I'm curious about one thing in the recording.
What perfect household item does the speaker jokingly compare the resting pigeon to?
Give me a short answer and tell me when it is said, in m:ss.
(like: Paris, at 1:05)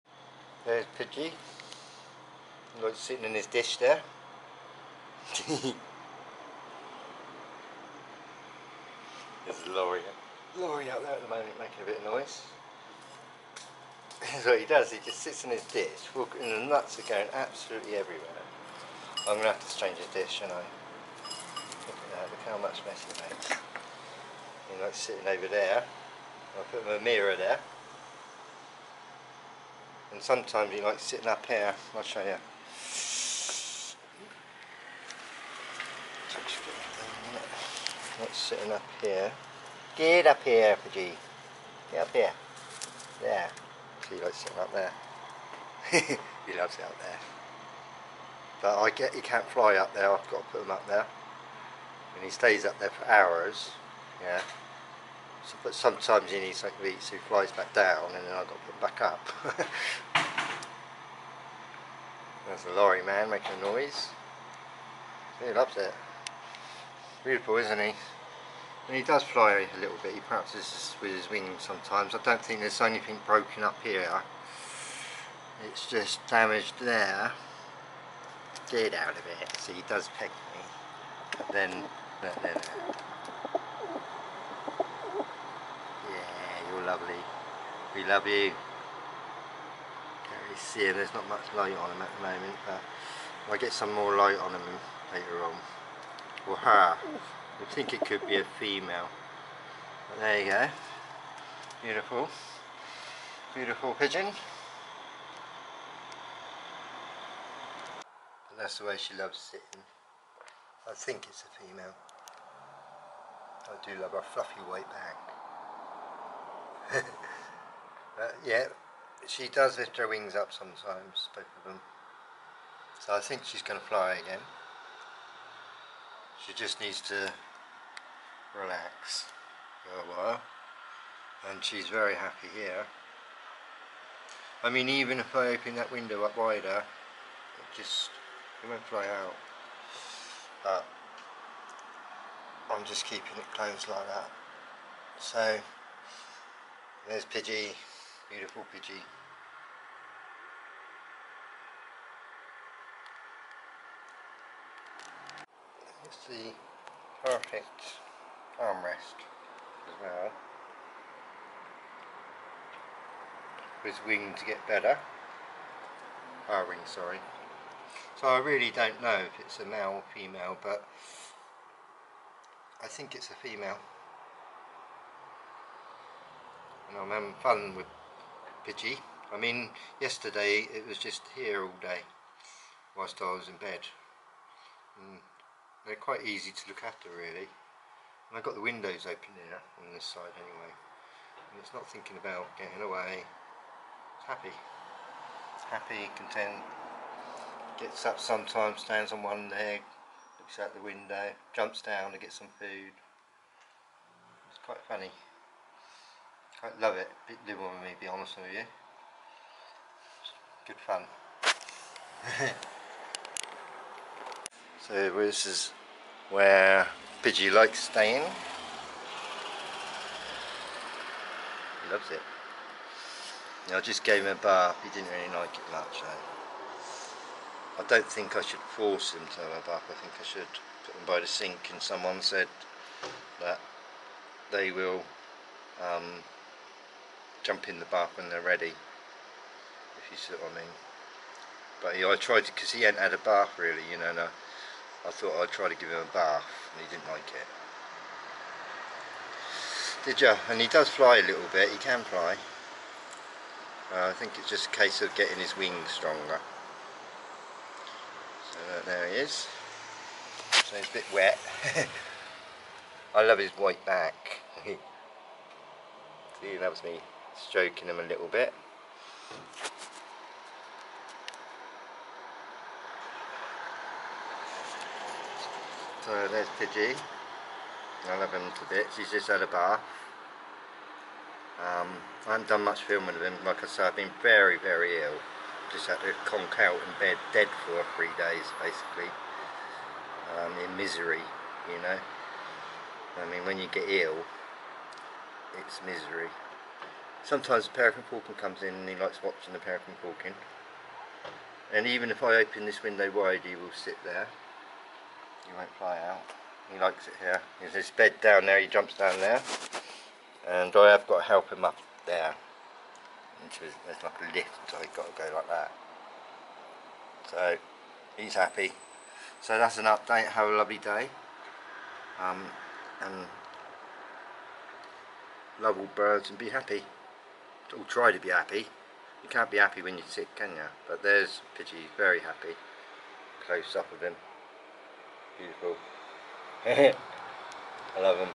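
Armrest, at 2:38.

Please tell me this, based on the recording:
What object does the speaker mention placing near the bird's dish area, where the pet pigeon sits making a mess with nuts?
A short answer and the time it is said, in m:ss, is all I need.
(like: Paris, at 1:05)
A mirror, at 0:27.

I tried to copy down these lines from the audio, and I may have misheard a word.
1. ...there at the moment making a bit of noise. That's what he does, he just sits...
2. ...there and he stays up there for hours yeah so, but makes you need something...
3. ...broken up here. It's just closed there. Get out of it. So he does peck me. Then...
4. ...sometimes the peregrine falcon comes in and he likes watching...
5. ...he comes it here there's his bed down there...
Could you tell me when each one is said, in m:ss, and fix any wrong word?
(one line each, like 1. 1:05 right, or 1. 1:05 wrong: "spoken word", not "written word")
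1. 0:11 right
2. 0:50 wrong: "sometimes", not "makes"
3. 1:13 wrong: "damaged", not "closed"
4. 4:57 right
5. 5:06 wrong: "likes", not "comes".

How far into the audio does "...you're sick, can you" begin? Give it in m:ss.
5:29.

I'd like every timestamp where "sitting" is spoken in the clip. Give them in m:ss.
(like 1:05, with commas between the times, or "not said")
0:02, 0:24, 0:30, 0:38, 0:44, 1:49.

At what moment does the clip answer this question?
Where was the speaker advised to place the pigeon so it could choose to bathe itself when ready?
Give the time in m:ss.
3:51.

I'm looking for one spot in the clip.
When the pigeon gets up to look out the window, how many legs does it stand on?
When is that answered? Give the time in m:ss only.
3:19.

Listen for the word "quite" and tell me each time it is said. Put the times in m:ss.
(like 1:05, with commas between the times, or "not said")
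3:05, 3:24.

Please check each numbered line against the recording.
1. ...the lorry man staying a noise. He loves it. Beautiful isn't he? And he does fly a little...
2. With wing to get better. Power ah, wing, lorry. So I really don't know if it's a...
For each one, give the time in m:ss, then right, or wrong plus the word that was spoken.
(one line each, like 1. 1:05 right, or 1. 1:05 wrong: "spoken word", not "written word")
1. 1:02 wrong: "making", not "staying"
2. 2:43 wrong: "sorry", not "lorry".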